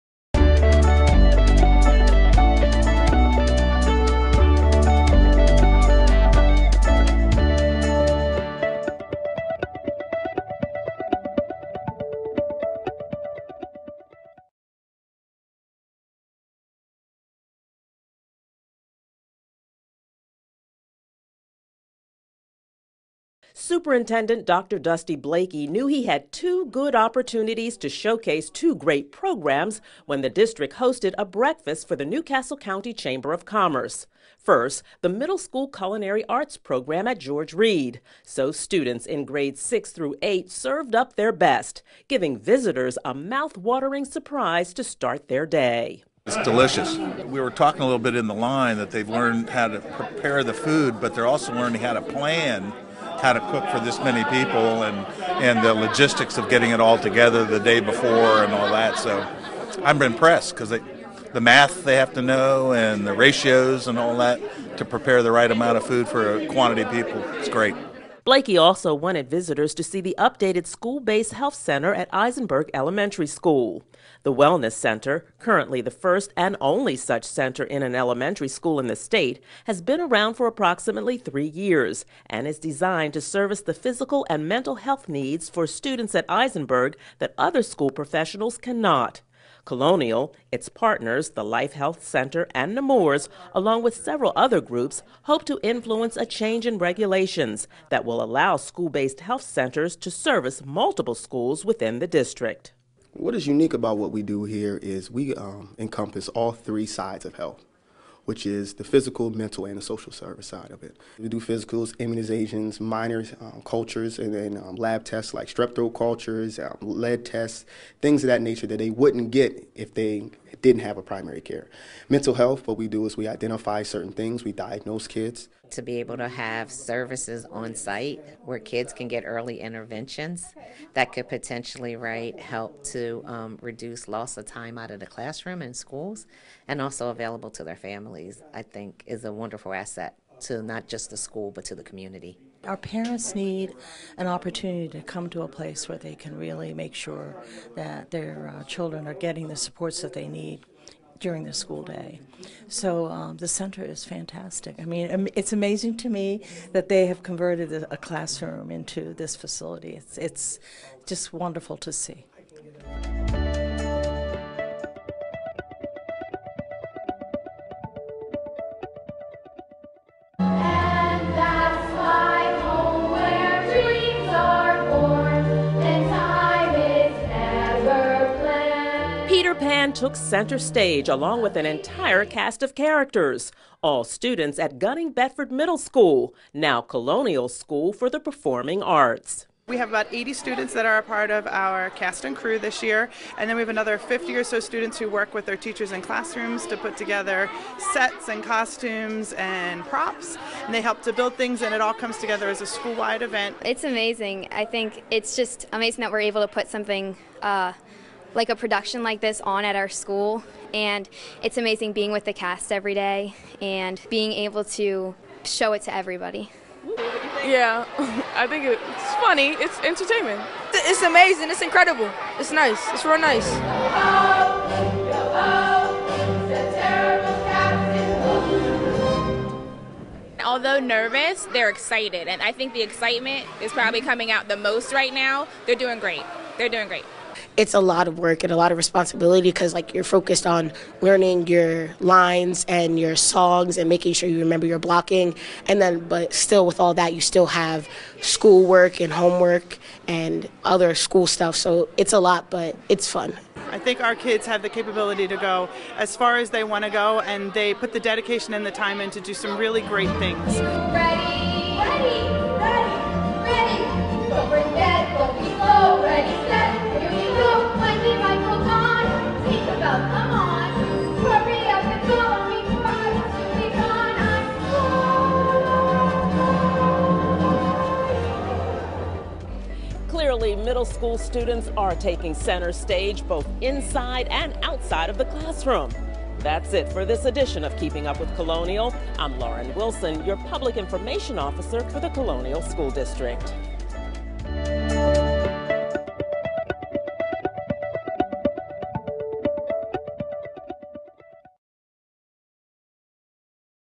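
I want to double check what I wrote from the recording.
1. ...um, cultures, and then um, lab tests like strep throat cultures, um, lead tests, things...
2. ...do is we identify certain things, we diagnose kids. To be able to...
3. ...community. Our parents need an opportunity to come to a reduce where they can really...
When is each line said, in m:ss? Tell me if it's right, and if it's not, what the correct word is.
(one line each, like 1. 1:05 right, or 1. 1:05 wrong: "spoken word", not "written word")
1. 1:53 right
2. 2:02 right
3. 2:21 wrong: "place", not "reduce".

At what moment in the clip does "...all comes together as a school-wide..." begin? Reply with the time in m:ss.
3:21.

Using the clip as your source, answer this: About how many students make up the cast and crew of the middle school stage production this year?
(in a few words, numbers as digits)
80.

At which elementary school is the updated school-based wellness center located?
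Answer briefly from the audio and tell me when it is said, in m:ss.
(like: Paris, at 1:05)
Eisenberg Elementary School, at 1:12.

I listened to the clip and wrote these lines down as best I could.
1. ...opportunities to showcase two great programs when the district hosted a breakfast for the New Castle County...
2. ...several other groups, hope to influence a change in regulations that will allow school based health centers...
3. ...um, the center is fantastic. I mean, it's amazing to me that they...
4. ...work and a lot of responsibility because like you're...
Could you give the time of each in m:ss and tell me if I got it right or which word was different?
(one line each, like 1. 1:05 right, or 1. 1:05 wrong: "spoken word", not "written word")
1. 0:26 right
2. 1:33 right
3. 2:33 right
4. 3:58 right.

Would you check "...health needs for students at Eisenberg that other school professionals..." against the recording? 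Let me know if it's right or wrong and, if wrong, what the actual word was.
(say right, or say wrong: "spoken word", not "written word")
right.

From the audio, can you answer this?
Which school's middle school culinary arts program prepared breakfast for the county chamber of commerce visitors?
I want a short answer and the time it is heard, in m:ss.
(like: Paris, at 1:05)
George Read, at 0:37.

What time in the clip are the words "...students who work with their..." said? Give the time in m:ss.
3:14.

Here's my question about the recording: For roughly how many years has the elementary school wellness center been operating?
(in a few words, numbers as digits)
3.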